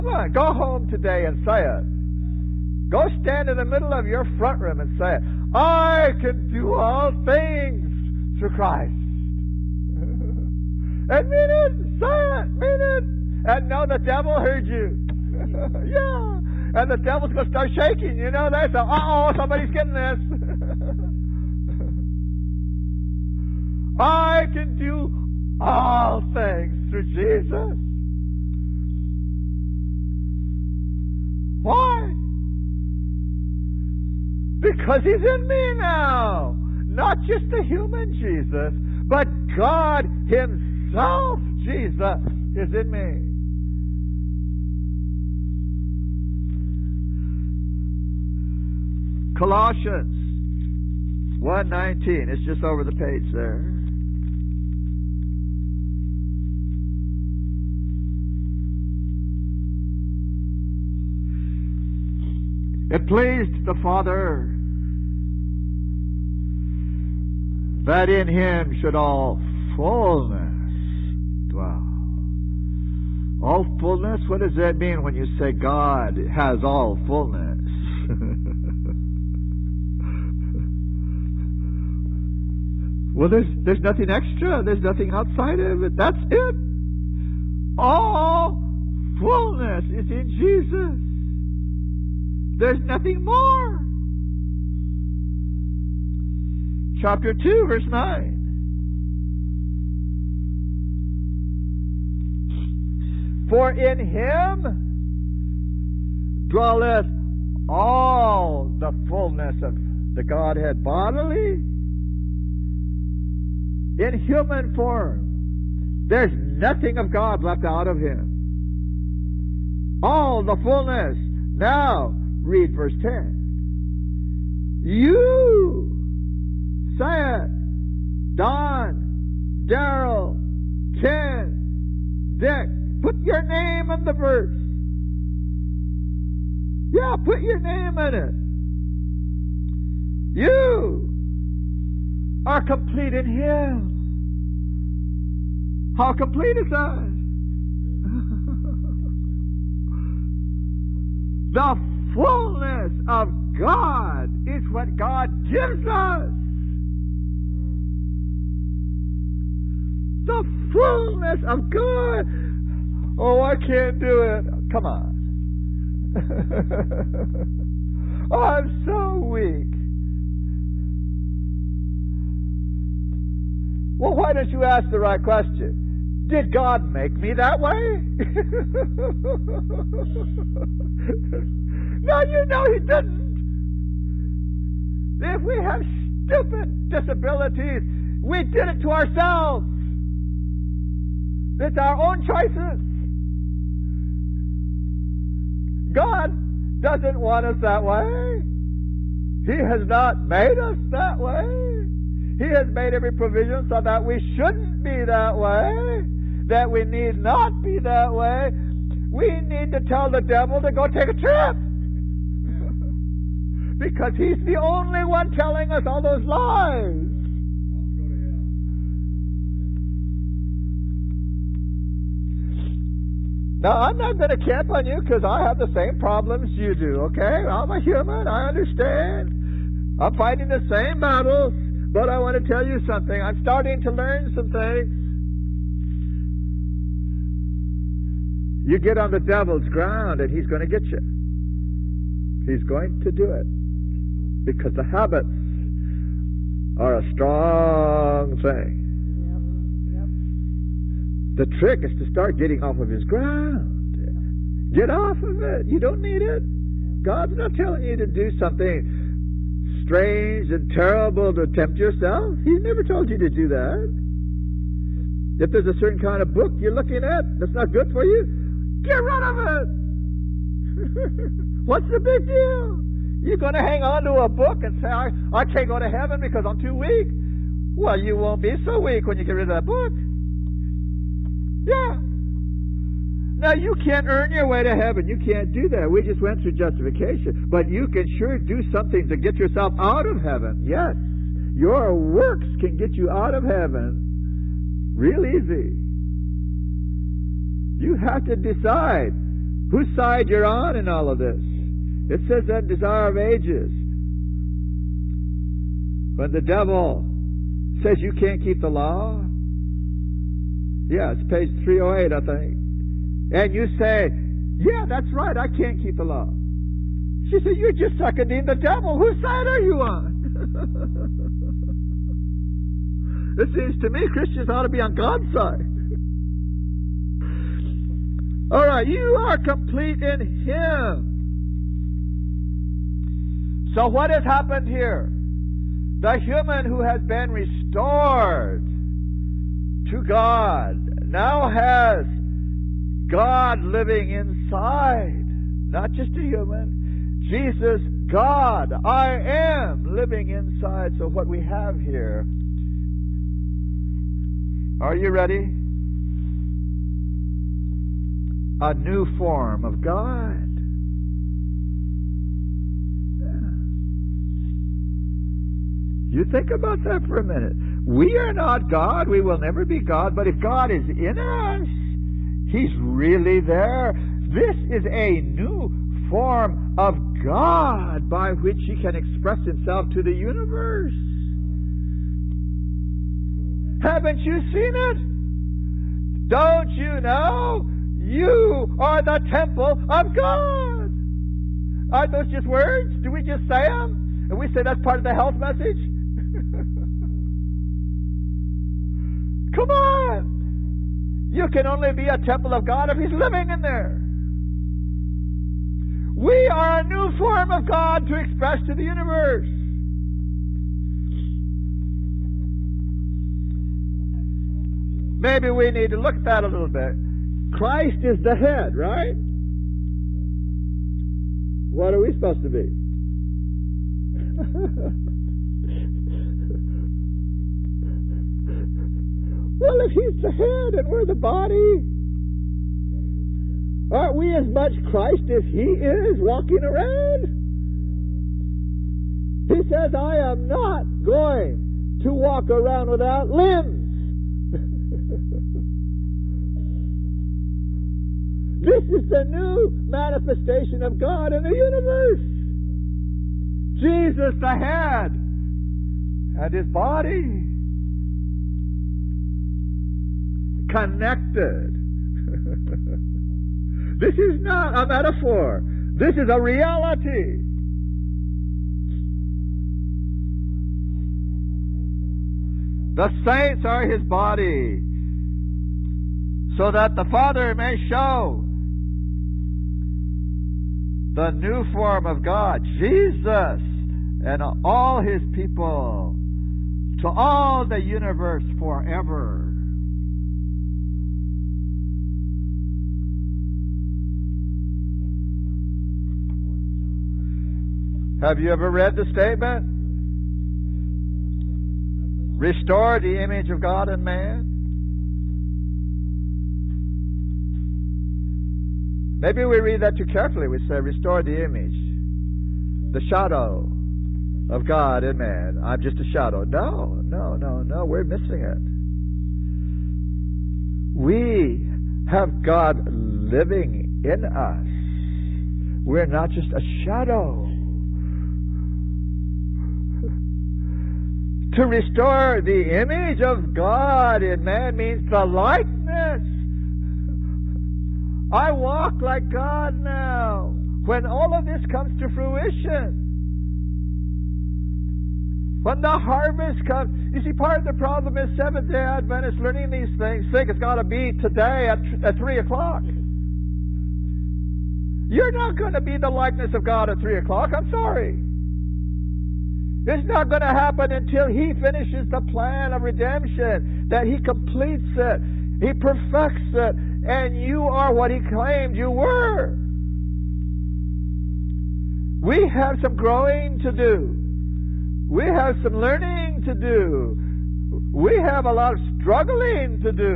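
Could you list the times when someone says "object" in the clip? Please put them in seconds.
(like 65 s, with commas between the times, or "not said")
not said.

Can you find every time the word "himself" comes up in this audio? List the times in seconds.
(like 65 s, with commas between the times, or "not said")
40 s, 379 s.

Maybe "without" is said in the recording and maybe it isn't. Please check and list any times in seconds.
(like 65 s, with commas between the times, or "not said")
442 s.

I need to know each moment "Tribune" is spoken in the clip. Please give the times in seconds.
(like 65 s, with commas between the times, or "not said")
not said.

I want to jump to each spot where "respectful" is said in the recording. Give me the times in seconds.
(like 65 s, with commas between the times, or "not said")
not said.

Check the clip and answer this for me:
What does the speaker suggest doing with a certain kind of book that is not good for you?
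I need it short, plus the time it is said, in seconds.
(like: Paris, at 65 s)
get rid of it, at 268 s.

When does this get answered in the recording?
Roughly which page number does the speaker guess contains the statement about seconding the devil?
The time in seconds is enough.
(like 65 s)
311 s.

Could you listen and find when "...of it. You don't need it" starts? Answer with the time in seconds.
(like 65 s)
255 s.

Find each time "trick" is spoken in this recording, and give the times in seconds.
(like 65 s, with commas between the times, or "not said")
251 s.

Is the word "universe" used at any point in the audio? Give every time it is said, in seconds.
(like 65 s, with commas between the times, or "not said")
380 s, 408 s, 451 s, 487 s.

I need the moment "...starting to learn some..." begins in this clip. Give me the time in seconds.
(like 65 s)
233 s.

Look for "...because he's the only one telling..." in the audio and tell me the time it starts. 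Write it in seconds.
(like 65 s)
213 s.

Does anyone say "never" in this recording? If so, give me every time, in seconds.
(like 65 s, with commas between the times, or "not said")
262 s, 369 s.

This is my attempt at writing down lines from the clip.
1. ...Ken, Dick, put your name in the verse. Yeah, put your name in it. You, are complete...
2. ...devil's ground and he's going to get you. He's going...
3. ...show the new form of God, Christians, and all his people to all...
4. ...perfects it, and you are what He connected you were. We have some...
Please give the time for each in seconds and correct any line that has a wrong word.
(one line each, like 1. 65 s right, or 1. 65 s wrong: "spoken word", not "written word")
1. 131 s right
2. 239 s right
3. 477 s wrong: "Jesus", not "Christians"
4. 565 s wrong: "claimed", not "connected".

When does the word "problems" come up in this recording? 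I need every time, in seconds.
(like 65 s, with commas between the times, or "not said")
225 s, 547 s.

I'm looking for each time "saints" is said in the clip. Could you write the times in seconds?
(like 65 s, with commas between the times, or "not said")
473 s.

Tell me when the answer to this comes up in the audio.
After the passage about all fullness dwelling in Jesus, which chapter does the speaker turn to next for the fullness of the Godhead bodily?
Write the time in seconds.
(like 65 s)
97 s.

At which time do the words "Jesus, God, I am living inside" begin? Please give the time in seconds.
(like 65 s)
347 s.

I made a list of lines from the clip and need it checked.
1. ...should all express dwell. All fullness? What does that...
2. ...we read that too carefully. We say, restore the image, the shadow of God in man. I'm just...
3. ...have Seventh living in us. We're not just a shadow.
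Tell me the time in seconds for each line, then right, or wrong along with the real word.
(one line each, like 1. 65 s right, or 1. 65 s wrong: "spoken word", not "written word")
1. 68 s wrong: "fullness", not "express"
2. 509 s right
3. 522 s wrong: "God", not "Seventh".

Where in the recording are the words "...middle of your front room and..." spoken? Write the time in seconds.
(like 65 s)
3 s.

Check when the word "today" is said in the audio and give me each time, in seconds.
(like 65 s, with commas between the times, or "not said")
0 s, 551 s.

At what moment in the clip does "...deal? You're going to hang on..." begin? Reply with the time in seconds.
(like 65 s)
272 s.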